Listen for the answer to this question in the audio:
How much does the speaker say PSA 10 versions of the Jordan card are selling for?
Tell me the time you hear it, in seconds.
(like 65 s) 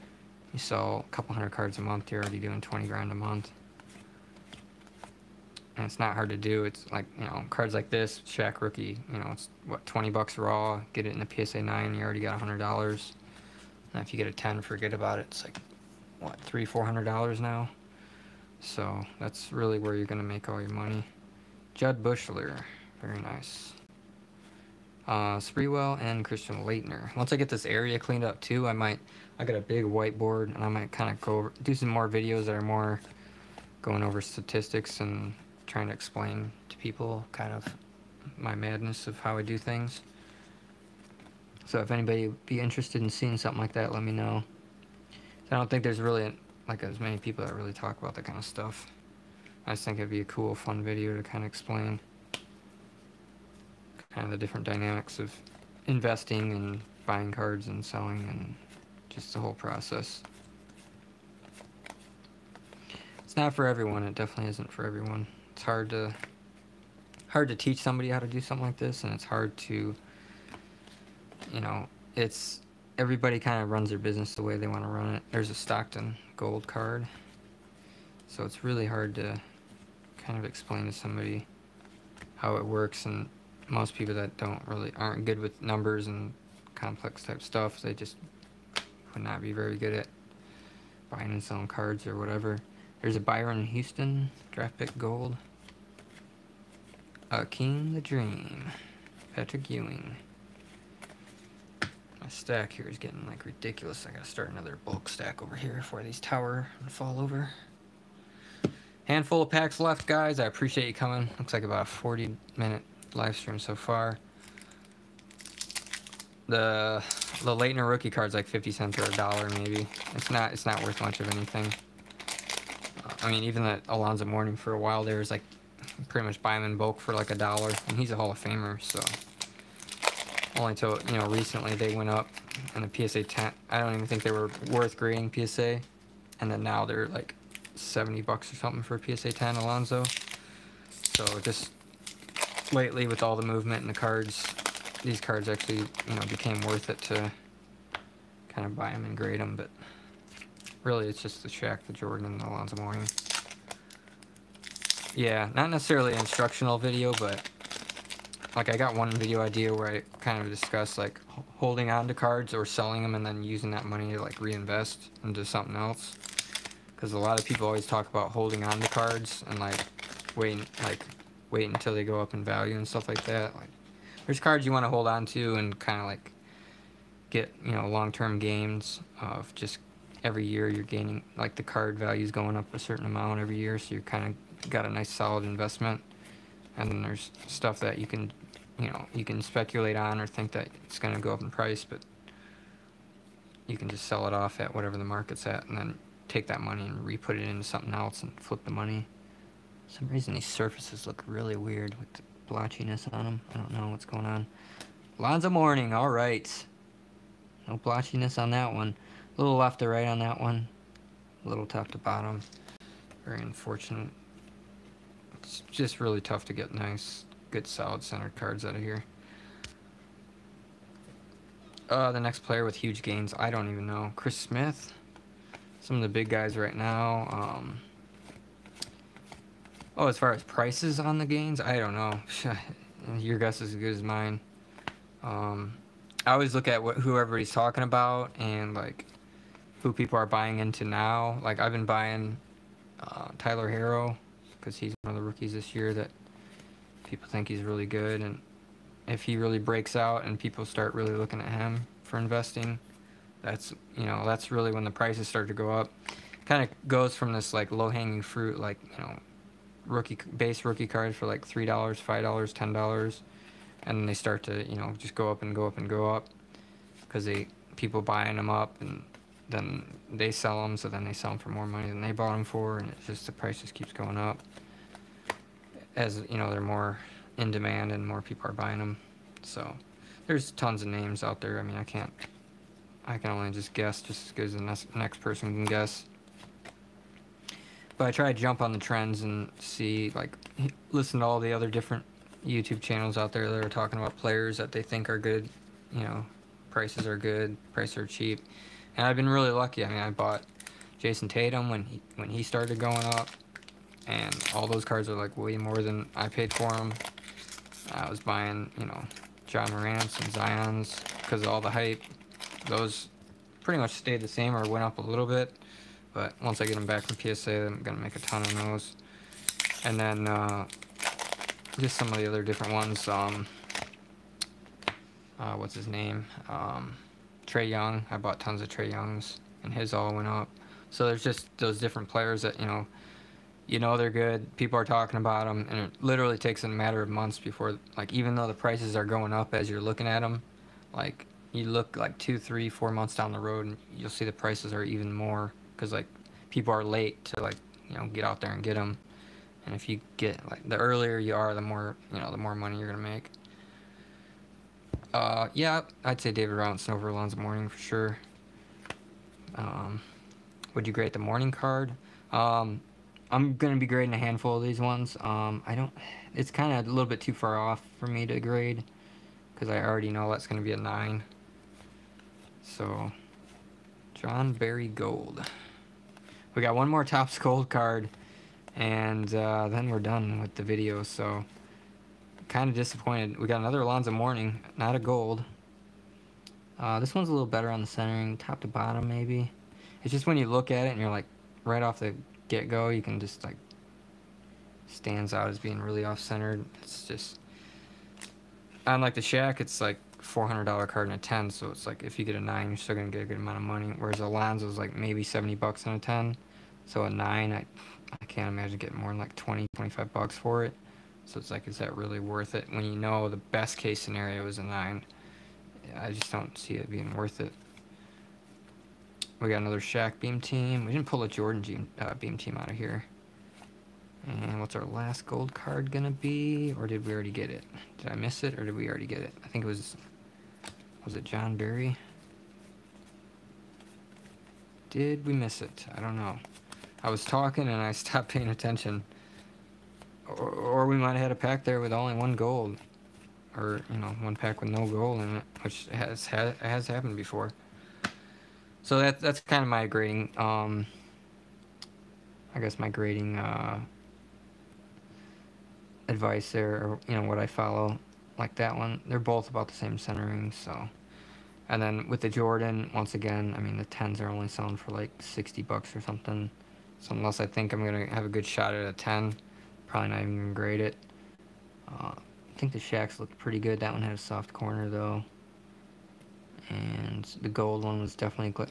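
465 s.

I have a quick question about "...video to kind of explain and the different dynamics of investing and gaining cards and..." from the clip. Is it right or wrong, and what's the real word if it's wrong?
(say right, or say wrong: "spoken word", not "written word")
wrong: "buying", not "gaining".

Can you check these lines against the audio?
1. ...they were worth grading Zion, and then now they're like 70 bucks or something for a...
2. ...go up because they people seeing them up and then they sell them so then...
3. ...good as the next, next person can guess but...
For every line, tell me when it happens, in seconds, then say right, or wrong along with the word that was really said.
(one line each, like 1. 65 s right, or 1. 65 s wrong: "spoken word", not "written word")
1. 134 s wrong: "PSA", not "Zion"
2. 265 s wrong: "buying", not "seeing"
3. 284 s right.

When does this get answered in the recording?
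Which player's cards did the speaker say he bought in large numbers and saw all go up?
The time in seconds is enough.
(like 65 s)
327 s.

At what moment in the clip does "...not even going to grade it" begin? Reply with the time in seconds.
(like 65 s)
470 s.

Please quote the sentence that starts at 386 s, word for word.
Uh, this one's a little better on the centering, top to bottom maybe.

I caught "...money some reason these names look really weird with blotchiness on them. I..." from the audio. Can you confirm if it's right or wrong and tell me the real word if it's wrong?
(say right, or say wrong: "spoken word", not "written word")
wrong: "surfaces", not "names".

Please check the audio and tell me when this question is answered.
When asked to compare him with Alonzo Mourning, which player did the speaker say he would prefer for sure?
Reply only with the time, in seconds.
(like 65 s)
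356 s.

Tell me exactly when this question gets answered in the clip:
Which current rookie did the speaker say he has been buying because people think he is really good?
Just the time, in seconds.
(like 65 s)
243 s.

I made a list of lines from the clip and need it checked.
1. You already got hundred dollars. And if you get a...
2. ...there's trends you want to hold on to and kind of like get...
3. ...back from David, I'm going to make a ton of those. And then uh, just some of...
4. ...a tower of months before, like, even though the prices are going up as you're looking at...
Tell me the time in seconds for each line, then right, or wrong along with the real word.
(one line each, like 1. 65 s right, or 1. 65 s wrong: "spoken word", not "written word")
1. 11 s right
2. 174 s wrong: "cards", not "trends"
3. 316 s wrong: "PSA", not "David"
4. 336 s wrong: "matter", not "tower".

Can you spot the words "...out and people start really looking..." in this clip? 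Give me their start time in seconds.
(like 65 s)
249 s.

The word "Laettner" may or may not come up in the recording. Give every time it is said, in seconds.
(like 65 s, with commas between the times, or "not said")
26 s, 117 s.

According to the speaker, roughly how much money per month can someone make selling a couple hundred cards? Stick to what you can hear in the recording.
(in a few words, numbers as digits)
$20,000.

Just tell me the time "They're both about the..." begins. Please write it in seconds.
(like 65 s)
459 s.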